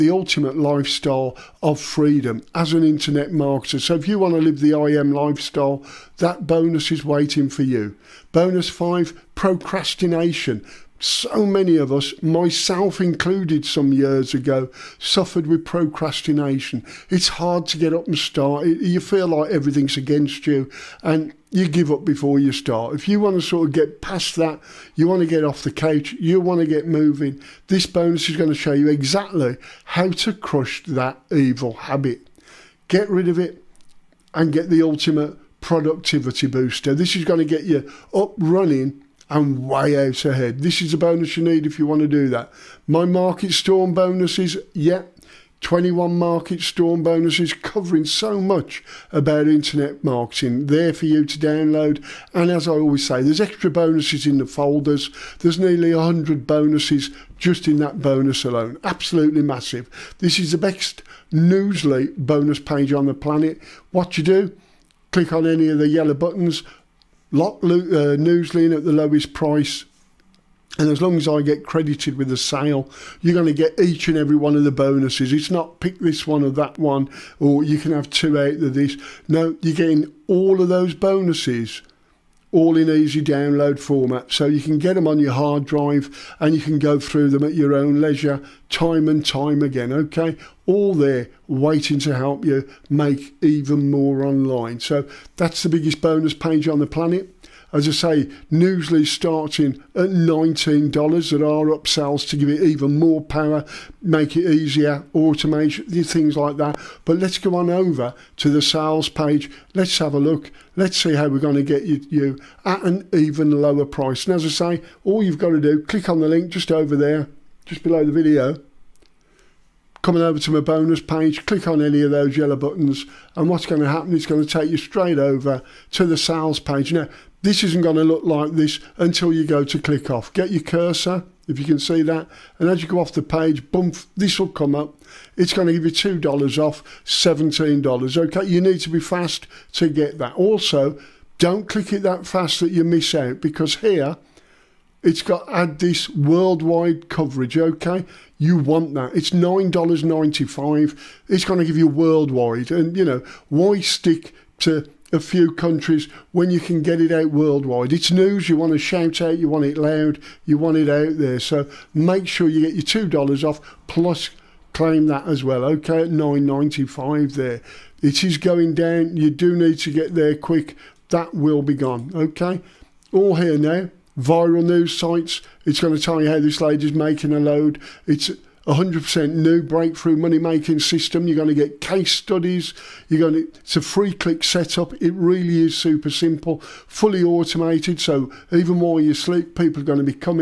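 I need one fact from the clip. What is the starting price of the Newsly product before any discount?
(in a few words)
$19.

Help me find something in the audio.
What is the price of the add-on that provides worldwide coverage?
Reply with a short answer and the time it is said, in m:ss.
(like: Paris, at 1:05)
$9.95, at 2:29.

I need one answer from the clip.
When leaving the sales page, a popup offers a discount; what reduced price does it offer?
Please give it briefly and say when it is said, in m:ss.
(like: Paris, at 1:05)
$17, at 2:17.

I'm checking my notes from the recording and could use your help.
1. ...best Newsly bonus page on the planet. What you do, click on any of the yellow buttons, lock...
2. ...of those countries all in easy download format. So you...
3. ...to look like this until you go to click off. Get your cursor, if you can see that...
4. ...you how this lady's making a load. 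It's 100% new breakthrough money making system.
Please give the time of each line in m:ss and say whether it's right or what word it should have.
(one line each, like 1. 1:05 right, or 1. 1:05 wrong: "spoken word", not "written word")
1. 1:00 right
2. 1:20 wrong: "bonuses", not "countries"
3. 2:07 right
4. 2:56 right.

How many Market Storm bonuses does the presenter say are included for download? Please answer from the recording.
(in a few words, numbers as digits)
21.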